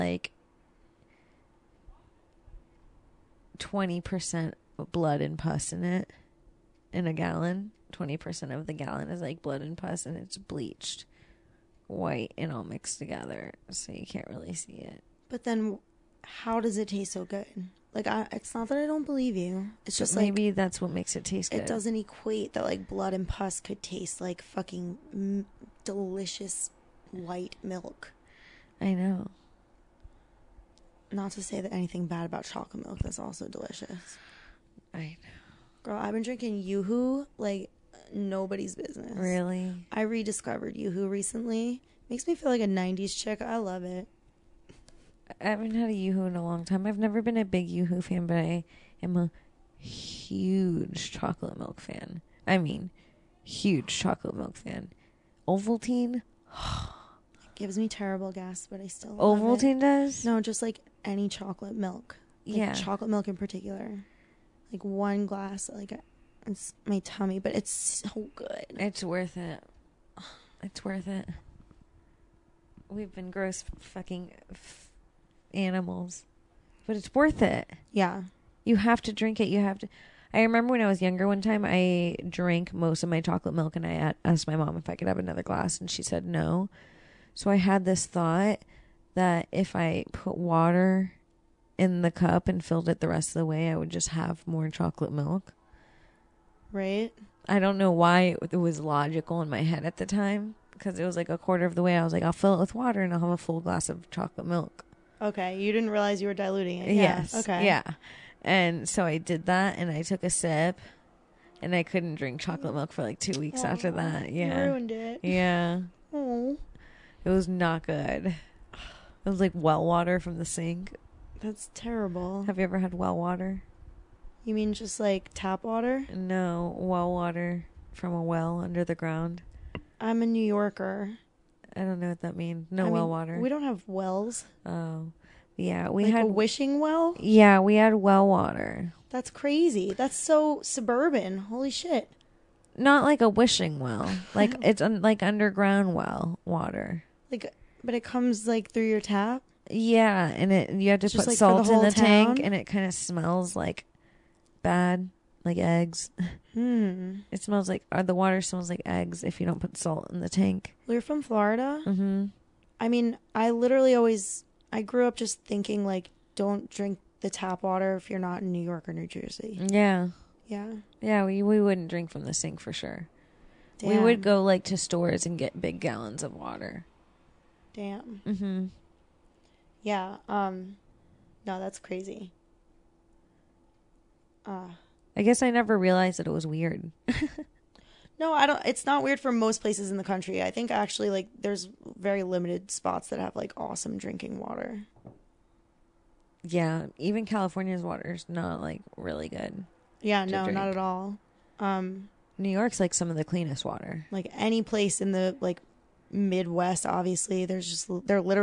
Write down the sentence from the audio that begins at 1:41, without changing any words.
I was like, I'll fill it with water and I'll have a full glass of chocolate milk.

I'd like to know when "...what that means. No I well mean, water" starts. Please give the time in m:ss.
2:12.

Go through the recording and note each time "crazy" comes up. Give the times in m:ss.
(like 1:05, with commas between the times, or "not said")
2:19, 3:01.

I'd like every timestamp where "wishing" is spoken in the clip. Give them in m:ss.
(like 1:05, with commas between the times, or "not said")
2:16, 2:23.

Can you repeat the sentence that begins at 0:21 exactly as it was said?
it doesn't equate that like blood and pus could taste like fucking m- delicious white milk.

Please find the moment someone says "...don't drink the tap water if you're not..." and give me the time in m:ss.
2:46.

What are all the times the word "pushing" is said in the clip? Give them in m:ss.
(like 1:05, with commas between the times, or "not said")
not said.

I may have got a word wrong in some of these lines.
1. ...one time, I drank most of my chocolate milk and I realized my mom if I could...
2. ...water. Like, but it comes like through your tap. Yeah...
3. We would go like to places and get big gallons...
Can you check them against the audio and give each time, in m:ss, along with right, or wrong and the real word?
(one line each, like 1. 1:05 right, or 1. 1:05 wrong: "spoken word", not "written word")
1. 1:21 wrong: "asked", not "realized"
2. 2:26 right
3. 2:53 wrong: "stores", not "places".